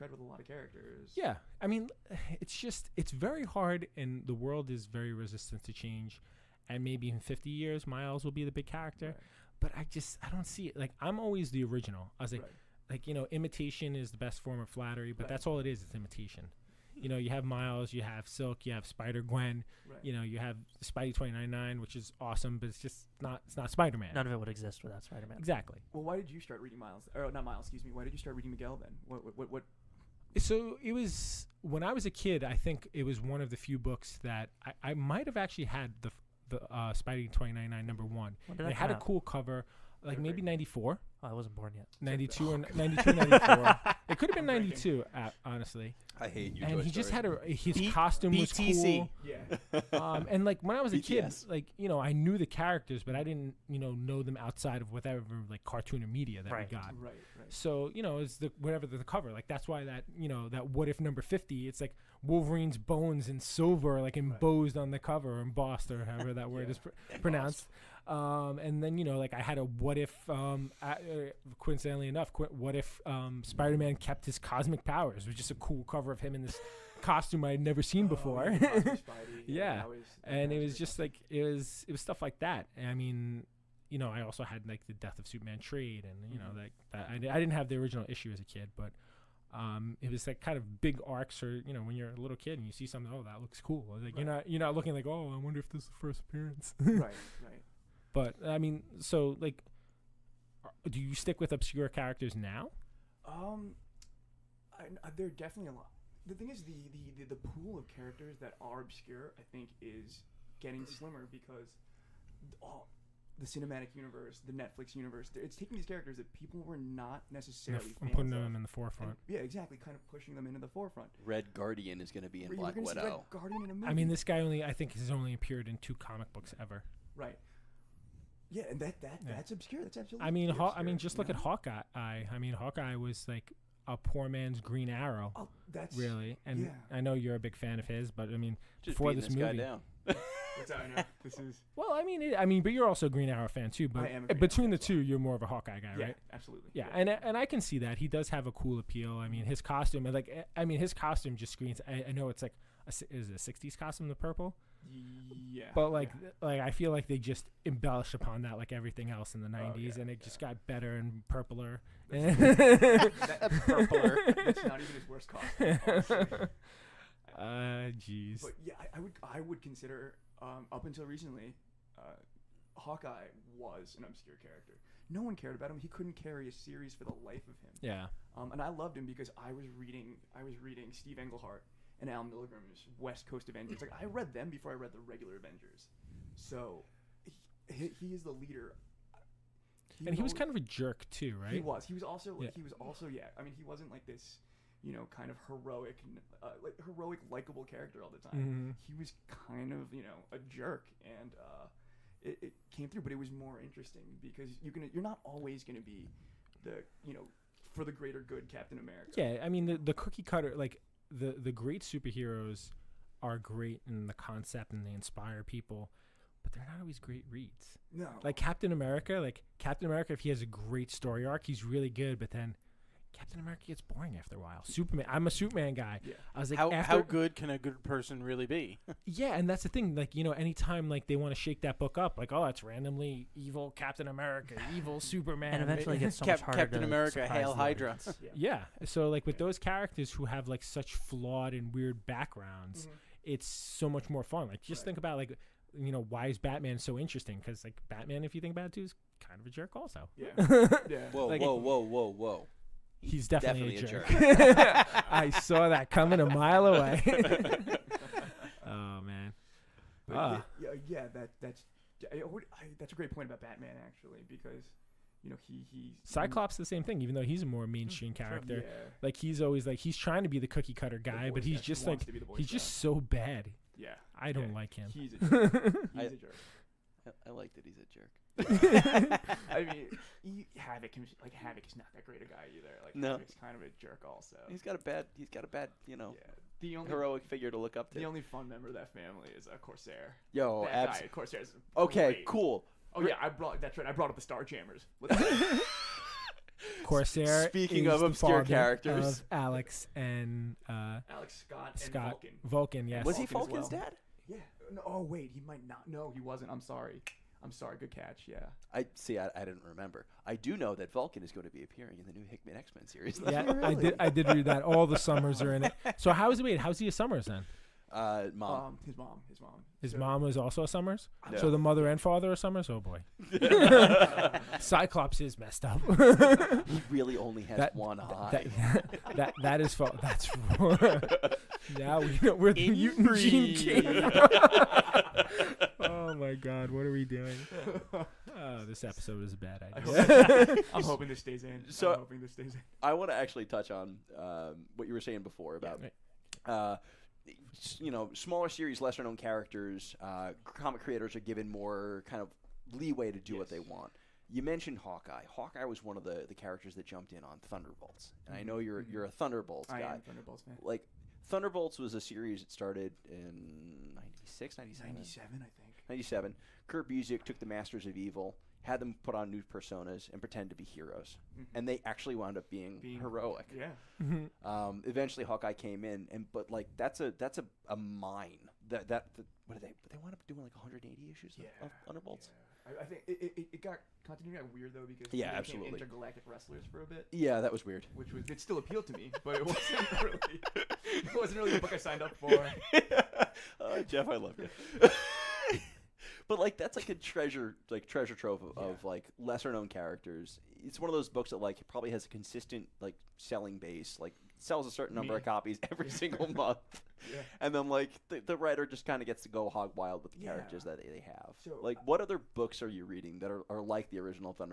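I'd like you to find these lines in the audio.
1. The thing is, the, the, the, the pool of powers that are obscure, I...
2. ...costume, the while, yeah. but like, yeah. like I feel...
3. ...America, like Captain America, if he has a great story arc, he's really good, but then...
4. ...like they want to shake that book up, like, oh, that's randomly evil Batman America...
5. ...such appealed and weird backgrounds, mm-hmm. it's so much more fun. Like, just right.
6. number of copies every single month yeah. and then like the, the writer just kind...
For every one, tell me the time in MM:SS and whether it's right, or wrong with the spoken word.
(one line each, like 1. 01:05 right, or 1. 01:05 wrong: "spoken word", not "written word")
1. 01:46 wrong: "characters", not "powers"
2. 02:33 wrong: "purple", not "while"
3. 03:38 right
4. 03:50 wrong: "Captain", not "Batman"
5. 04:00 wrong: "flawed", not "appealed"
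6. 06:45 right.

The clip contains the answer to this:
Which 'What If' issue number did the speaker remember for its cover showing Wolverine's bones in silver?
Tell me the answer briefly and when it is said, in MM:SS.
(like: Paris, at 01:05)
50, at 01:00.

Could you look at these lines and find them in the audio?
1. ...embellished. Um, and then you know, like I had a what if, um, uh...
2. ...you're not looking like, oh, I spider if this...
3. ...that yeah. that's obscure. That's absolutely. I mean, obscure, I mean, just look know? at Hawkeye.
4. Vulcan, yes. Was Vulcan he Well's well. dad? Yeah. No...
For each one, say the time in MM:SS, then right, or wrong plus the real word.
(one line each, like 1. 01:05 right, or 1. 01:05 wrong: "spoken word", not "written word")
1. 01:07 wrong: "pronounced", not "embellished"
2. 01:34 wrong: "wonder", not "spider"
3. 02:09 right
4. 05:02 wrong: "Vulcan", not "Well".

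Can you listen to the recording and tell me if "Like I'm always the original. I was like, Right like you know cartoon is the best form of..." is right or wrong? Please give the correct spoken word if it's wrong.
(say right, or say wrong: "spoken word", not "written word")
wrong: "imitation", not "cartoon".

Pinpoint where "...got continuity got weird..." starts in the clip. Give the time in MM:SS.
06:23.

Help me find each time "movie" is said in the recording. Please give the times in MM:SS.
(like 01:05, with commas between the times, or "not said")
02:03, 02:19.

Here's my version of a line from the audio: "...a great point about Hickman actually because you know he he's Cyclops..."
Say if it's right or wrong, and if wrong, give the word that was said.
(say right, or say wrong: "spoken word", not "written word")
wrong: "Batman", not "Hickman".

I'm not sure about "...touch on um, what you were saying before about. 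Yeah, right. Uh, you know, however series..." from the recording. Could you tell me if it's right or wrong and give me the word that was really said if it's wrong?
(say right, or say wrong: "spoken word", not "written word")
wrong: "smaller", not "however".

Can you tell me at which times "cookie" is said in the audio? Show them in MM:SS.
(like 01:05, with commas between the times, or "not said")
03:29, 04:30.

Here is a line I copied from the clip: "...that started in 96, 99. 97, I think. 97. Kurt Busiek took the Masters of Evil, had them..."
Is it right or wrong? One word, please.
wrong.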